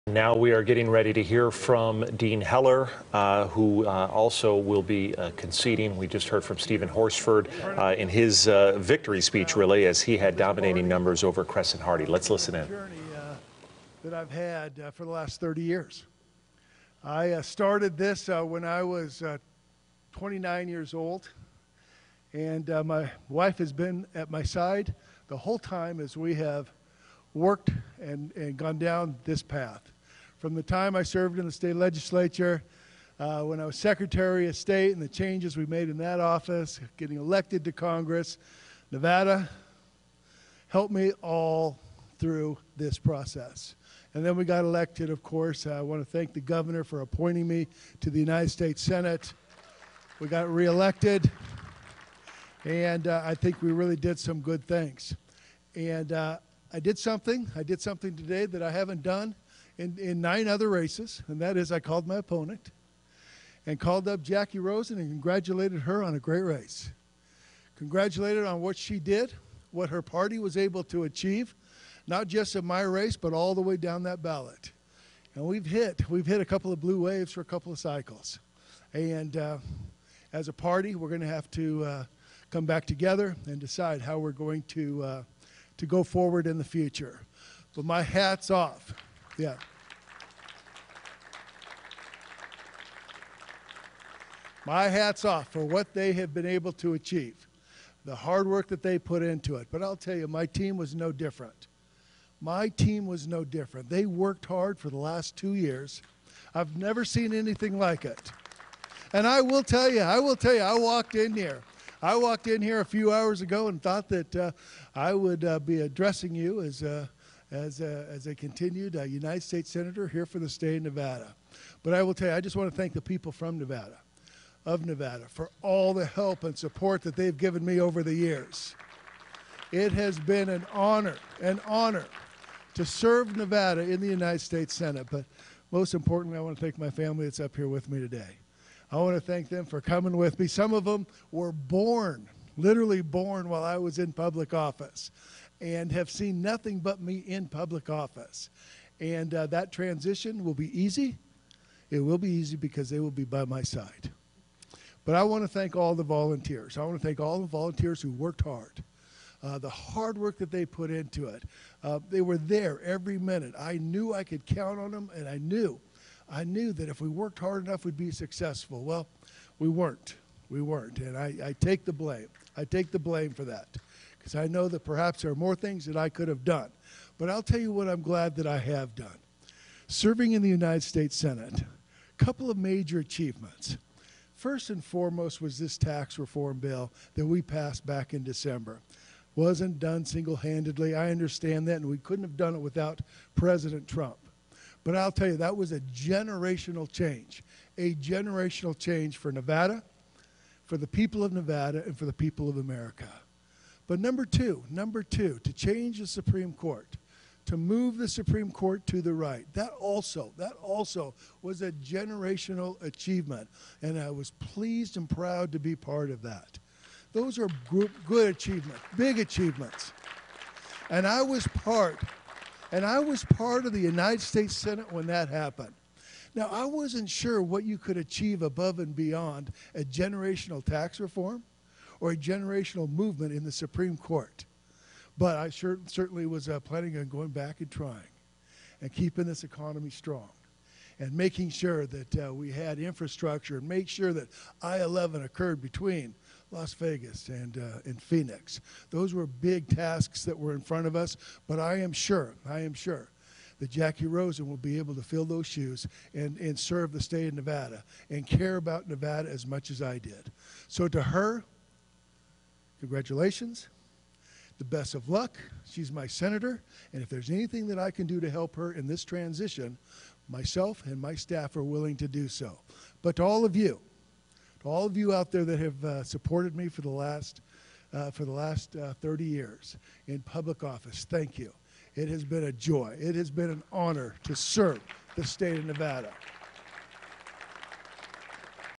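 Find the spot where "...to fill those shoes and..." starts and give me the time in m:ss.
4:14.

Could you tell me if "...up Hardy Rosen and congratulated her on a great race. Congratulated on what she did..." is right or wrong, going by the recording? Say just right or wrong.
wrong.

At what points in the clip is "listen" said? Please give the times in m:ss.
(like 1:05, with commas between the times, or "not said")
0:12.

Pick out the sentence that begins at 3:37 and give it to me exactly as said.
Those are good achievements, big achievements.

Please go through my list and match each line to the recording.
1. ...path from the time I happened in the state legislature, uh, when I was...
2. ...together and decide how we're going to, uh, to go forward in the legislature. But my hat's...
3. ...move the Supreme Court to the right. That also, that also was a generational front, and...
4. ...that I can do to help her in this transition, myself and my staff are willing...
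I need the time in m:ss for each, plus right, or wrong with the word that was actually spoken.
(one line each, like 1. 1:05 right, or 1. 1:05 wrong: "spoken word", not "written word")
1. 0:29 wrong: "served", not "happened"
2. 1:22 wrong: "future", not "legislature"
3. 3:27 wrong: "achievement", not "front"
4. 4:27 right.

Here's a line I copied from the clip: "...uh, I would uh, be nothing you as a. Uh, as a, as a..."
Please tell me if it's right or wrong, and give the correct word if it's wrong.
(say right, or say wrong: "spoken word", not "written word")
wrong: "addressing", not "nothing".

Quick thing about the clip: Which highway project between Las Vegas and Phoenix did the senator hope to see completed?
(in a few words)
I-11.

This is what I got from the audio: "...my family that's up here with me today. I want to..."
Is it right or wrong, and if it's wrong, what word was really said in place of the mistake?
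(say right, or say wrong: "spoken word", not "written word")
right.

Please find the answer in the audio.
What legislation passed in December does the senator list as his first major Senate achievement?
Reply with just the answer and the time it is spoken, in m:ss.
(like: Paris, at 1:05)
tax reform bill, at 3:05.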